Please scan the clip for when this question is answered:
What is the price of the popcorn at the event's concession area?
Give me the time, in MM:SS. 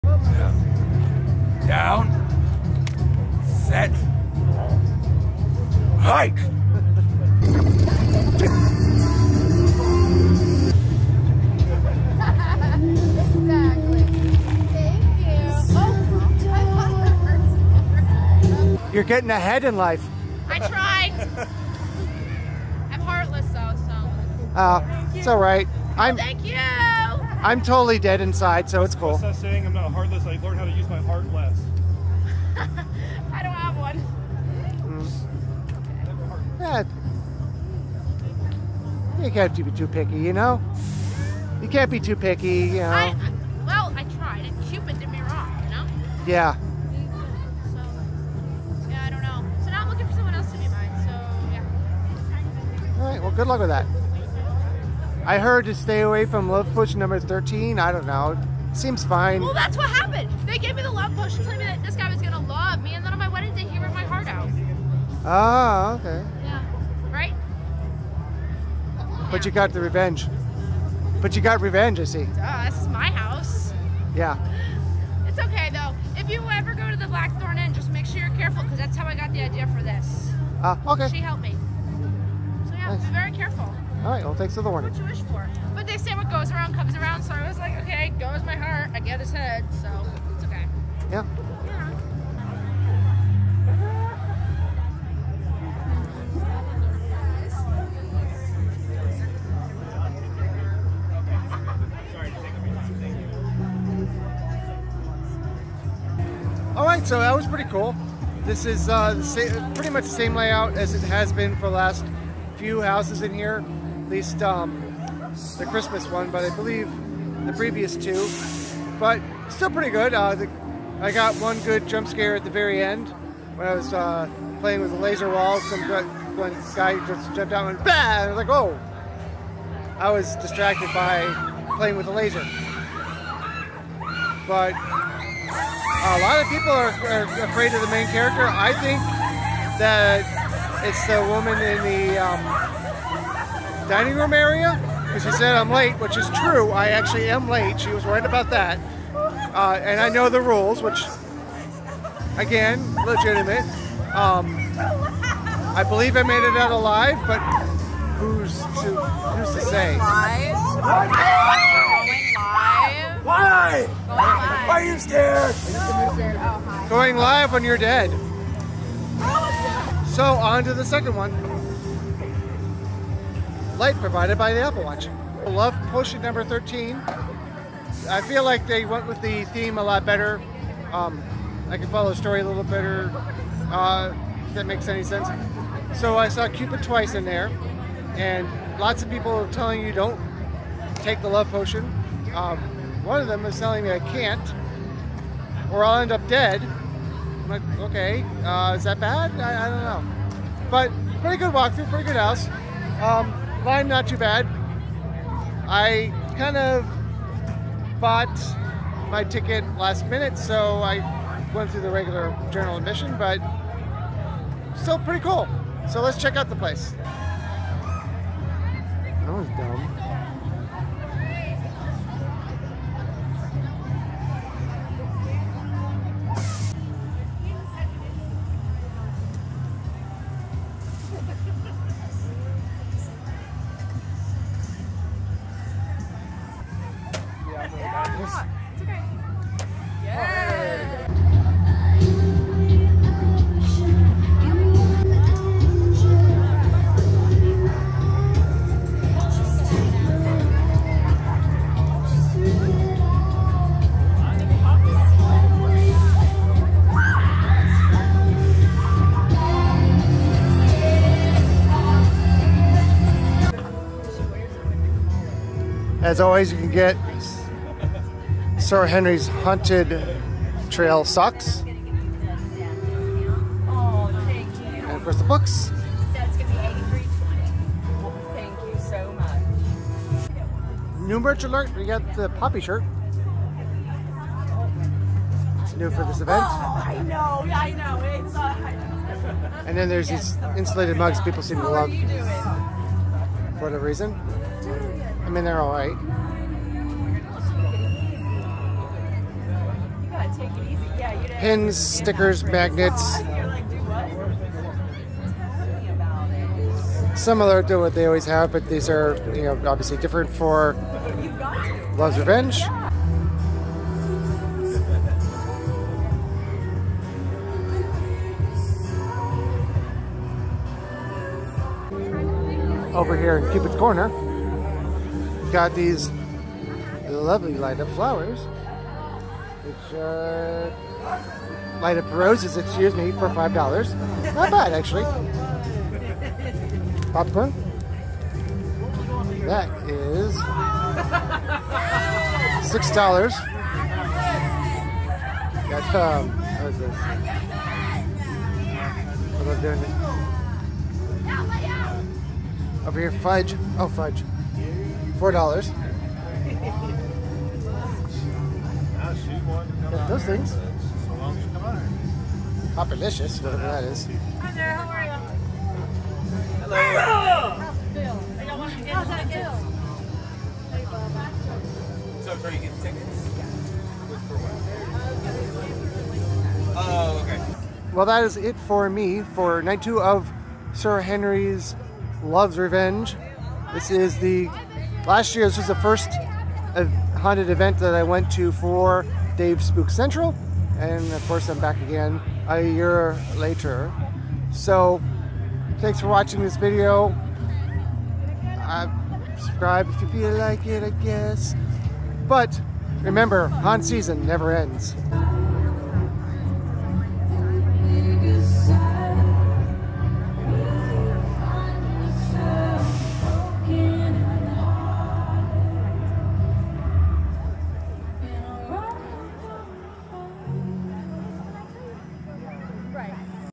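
05:42.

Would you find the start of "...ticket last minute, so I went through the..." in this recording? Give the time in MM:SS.
03:29.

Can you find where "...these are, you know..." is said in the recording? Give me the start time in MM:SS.
05:08.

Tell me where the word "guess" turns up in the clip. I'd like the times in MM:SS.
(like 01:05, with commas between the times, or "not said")
06:41.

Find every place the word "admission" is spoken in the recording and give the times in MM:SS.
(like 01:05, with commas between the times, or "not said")
03:32.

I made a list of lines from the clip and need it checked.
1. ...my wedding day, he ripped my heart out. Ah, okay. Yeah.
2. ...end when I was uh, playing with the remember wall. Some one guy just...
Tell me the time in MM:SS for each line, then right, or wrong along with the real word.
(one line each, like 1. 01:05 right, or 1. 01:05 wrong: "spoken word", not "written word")
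1. 01:03 right
2. 02:02 wrong: "laser", not "remember".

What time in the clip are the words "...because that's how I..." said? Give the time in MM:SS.
01:18.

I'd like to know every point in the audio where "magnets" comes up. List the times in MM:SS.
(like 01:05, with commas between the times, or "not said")
05:02.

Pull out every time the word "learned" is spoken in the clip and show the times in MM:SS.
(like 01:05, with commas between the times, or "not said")
00:30.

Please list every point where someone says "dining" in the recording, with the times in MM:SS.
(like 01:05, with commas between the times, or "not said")
02:23.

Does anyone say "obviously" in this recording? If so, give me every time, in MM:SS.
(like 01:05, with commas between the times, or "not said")
05:09.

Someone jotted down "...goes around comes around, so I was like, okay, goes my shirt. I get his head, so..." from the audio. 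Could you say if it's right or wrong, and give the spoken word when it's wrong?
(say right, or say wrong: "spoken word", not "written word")
wrong: "heart", not "shirt".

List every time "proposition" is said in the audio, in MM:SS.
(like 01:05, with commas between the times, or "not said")
not said.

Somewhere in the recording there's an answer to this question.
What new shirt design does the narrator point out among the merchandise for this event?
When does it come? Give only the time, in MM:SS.
04:42.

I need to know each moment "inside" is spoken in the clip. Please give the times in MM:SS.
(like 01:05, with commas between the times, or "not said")
00:28.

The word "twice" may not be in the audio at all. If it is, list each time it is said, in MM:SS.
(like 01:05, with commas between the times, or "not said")
03:06.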